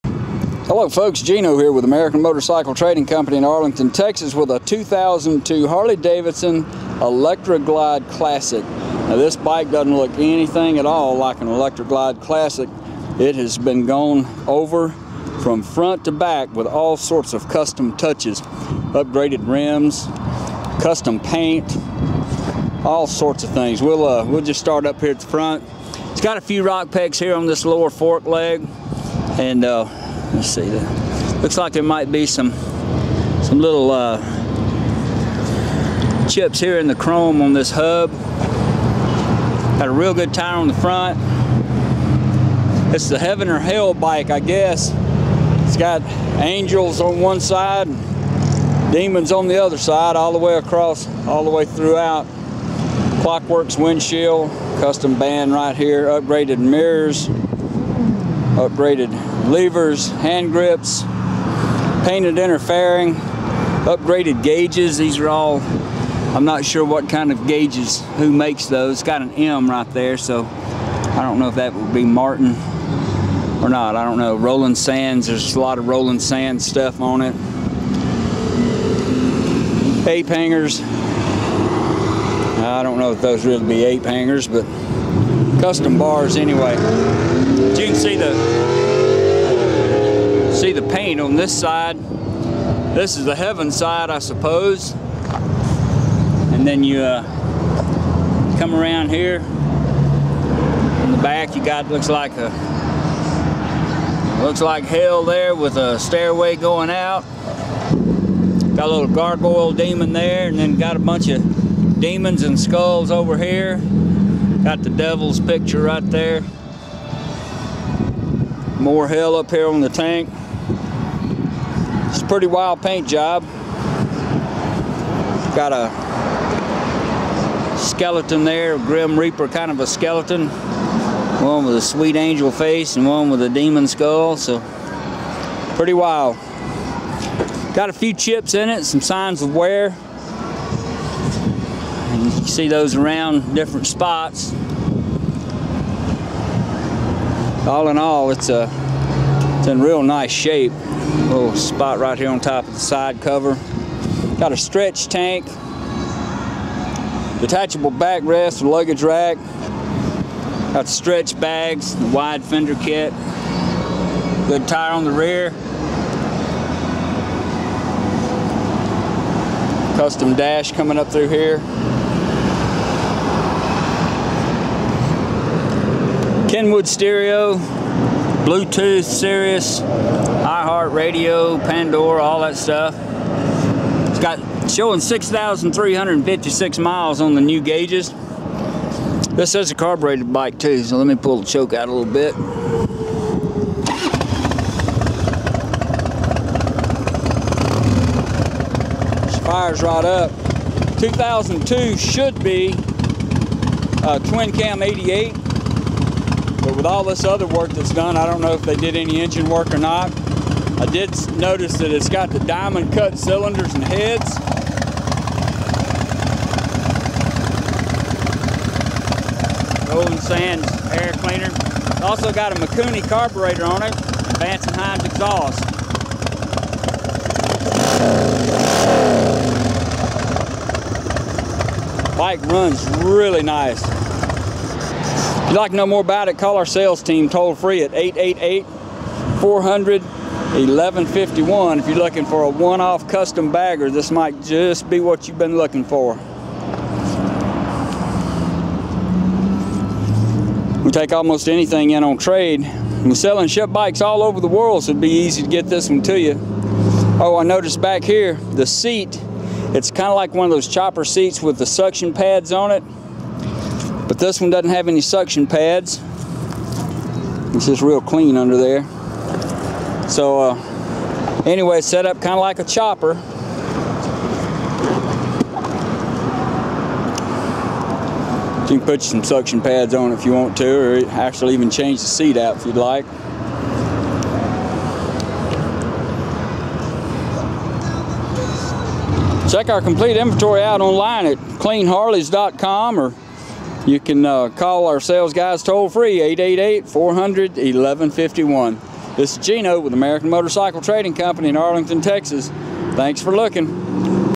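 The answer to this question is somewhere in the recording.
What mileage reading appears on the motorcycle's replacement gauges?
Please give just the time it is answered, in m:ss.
3:04.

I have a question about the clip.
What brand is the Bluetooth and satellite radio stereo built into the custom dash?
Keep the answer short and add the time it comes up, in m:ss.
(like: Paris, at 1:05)
Kenwood, at 2:56.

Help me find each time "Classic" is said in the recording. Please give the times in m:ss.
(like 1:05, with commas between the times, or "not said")
0:08, 0:12.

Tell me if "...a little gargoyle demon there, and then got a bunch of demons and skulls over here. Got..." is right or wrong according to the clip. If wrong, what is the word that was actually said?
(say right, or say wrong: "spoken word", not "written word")
right.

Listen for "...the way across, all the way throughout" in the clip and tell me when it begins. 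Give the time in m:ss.
0:50.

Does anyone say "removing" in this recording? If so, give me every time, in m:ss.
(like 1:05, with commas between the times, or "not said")
not said.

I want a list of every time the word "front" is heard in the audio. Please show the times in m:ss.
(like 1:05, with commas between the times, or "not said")
0:15, 0:25, 0:40.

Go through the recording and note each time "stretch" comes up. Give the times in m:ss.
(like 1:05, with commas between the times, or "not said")
2:34, 2:40.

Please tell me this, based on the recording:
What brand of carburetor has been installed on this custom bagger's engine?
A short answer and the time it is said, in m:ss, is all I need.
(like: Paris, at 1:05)
Mikuni, at 3:42.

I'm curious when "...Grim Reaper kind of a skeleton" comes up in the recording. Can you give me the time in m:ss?
2:08.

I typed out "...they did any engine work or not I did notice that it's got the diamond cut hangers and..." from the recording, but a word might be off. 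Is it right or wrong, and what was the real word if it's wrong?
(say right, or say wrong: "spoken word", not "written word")
wrong: "cylinders", not "hangers".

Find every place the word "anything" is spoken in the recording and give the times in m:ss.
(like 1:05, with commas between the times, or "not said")
0:10, 4:11.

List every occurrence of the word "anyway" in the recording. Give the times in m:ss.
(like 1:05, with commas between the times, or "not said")
1:26, 4:31.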